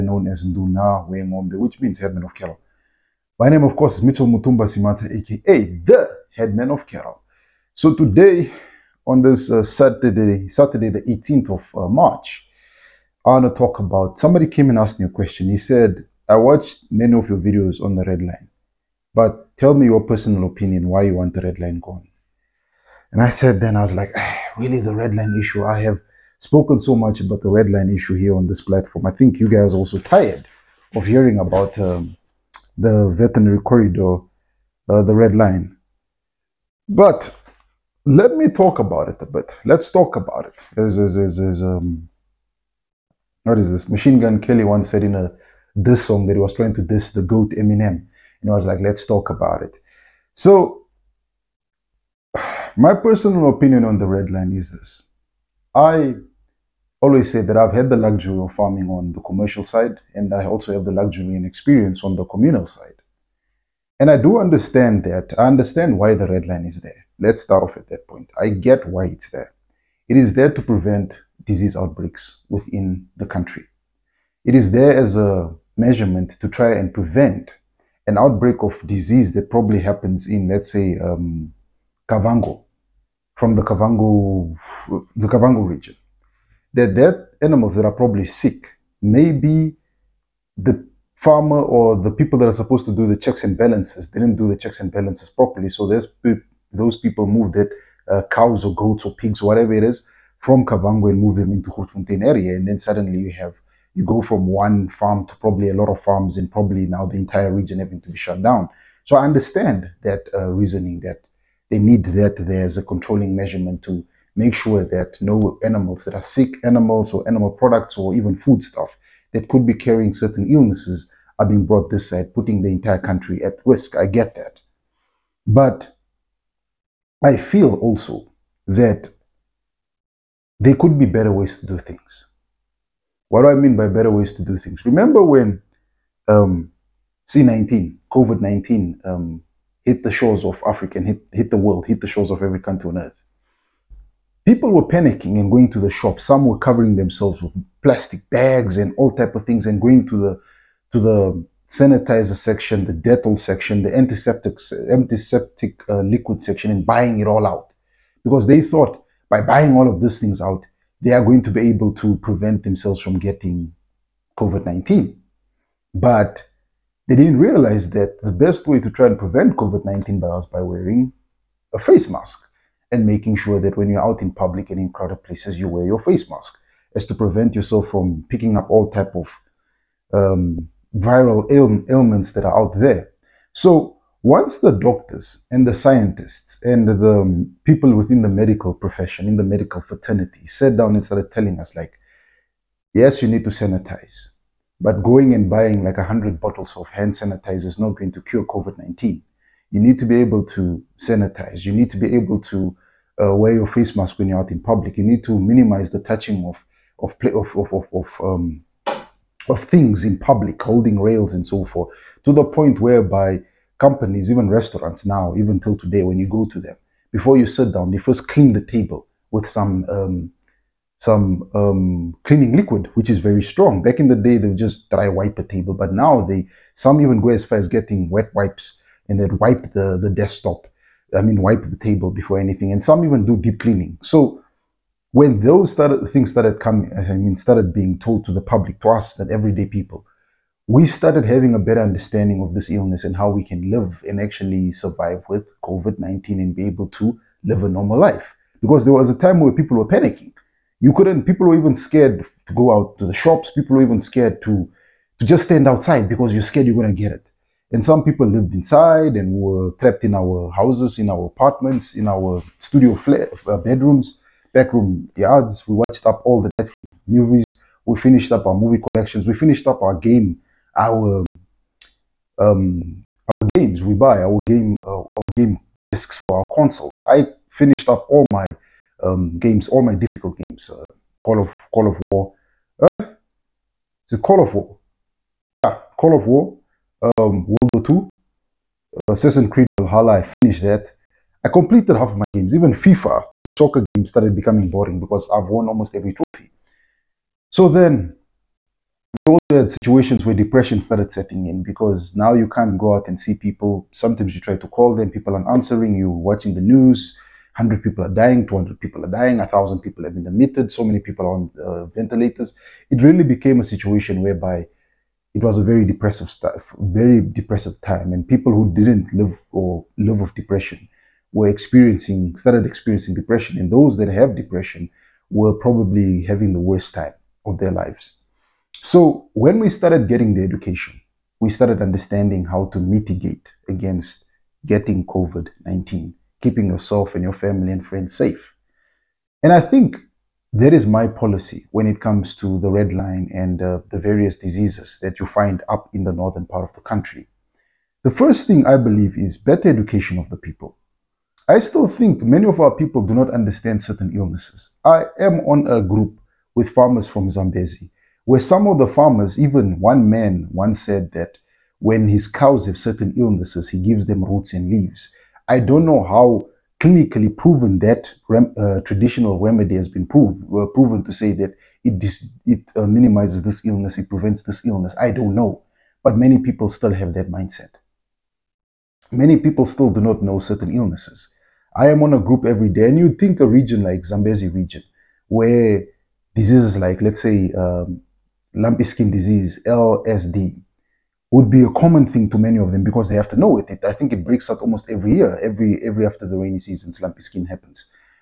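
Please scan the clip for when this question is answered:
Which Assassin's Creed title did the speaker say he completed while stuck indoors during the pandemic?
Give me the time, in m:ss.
4:49.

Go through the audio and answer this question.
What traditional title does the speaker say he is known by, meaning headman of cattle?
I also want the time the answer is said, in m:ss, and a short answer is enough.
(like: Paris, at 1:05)
Nduna Wengombe, at 0:00.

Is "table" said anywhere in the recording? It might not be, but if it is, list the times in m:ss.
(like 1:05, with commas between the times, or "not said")
3:38, 3:45, 3:51.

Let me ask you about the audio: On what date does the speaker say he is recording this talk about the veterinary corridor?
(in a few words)
Saturday the 18th of March.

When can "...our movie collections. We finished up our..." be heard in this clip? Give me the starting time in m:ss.
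4:28.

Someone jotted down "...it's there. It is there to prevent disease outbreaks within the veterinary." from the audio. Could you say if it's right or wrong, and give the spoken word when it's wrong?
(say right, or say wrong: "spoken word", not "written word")
wrong: "country", not "veterinary".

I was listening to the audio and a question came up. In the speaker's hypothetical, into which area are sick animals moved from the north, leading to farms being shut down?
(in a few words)
Grootfontein.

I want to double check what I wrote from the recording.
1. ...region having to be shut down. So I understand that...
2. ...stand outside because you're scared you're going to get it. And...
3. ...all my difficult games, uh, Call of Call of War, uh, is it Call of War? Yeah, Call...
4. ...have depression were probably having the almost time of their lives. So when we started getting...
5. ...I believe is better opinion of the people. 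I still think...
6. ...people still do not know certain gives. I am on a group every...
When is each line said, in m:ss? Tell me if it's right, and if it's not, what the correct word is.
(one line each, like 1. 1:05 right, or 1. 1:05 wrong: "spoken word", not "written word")
1. 1:47 right
2. 4:15 right
3. 4:39 right
4. 5:24 wrong: "worst", not "almost"
5. 5:48 wrong: "education", not "opinion"
6. 6:19 wrong: "illnesses", not "gives".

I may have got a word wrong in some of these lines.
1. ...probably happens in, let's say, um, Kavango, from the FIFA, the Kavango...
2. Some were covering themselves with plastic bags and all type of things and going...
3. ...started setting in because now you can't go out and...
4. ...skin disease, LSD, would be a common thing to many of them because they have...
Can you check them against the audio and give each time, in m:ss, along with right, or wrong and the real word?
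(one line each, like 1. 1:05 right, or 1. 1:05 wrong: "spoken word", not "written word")
1. 1:19 wrong: "Kavango", not "FIFA"
2. 2:26 right
3. 5:00 right
4. 6:28 right.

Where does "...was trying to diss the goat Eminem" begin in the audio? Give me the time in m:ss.
0:46.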